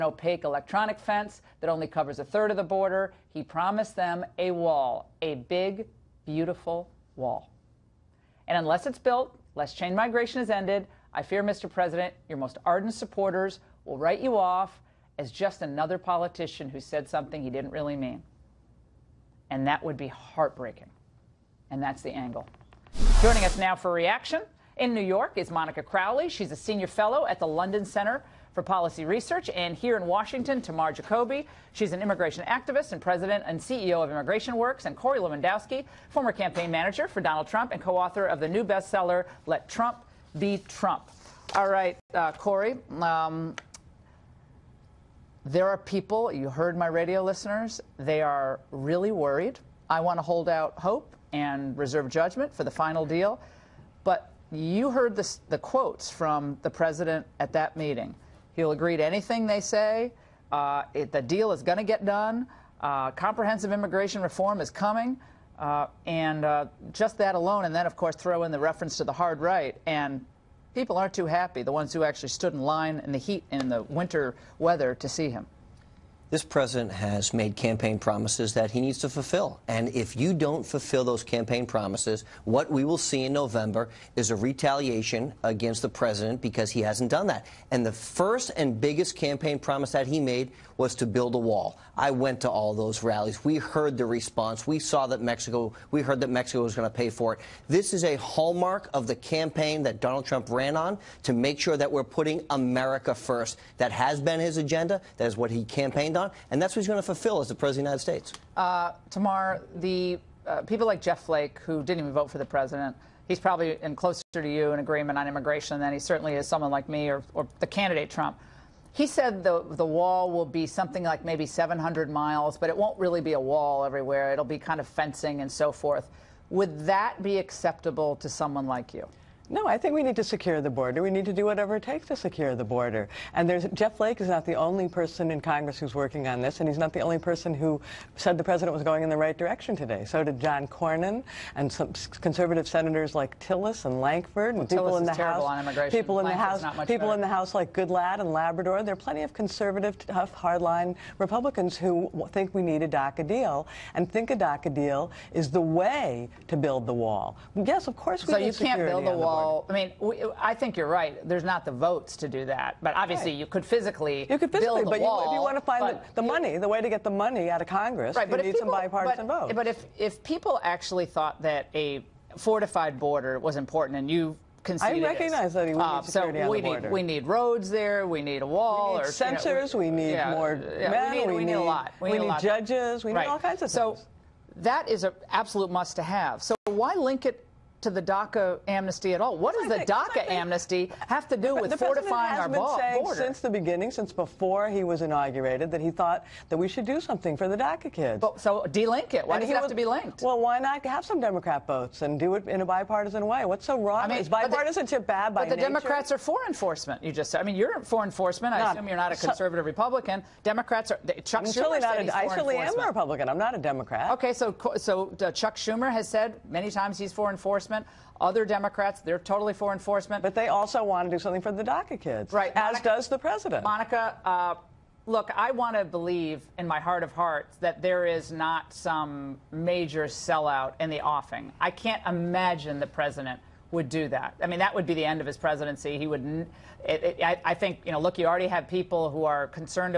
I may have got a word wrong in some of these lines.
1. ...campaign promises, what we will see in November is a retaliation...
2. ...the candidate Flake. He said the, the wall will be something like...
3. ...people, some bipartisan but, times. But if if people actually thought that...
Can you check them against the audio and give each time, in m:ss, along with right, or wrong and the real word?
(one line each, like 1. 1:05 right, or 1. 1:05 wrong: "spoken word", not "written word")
1. 1:21 right
2. 1:57 wrong: "Trump", not "Flake"
3. 2:48 wrong: "votes", not "times".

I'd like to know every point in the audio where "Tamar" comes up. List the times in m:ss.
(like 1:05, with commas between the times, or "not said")
0:30, 1:49.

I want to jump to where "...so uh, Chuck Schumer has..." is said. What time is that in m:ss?
3:34.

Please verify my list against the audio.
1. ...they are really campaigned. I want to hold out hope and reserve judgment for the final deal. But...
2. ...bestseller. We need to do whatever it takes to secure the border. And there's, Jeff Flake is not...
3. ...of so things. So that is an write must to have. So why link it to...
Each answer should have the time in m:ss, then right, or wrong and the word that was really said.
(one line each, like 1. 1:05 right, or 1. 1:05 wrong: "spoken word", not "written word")
1. 0:47 wrong: "worried", not "campaigned"
2. 2:10 wrong: "border", not "bestseller"
3. 3:03 wrong: "absolute", not "write".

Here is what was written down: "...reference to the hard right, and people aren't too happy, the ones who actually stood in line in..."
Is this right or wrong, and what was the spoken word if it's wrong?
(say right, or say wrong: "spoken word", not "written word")
right.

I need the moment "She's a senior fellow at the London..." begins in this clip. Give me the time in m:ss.
0:26.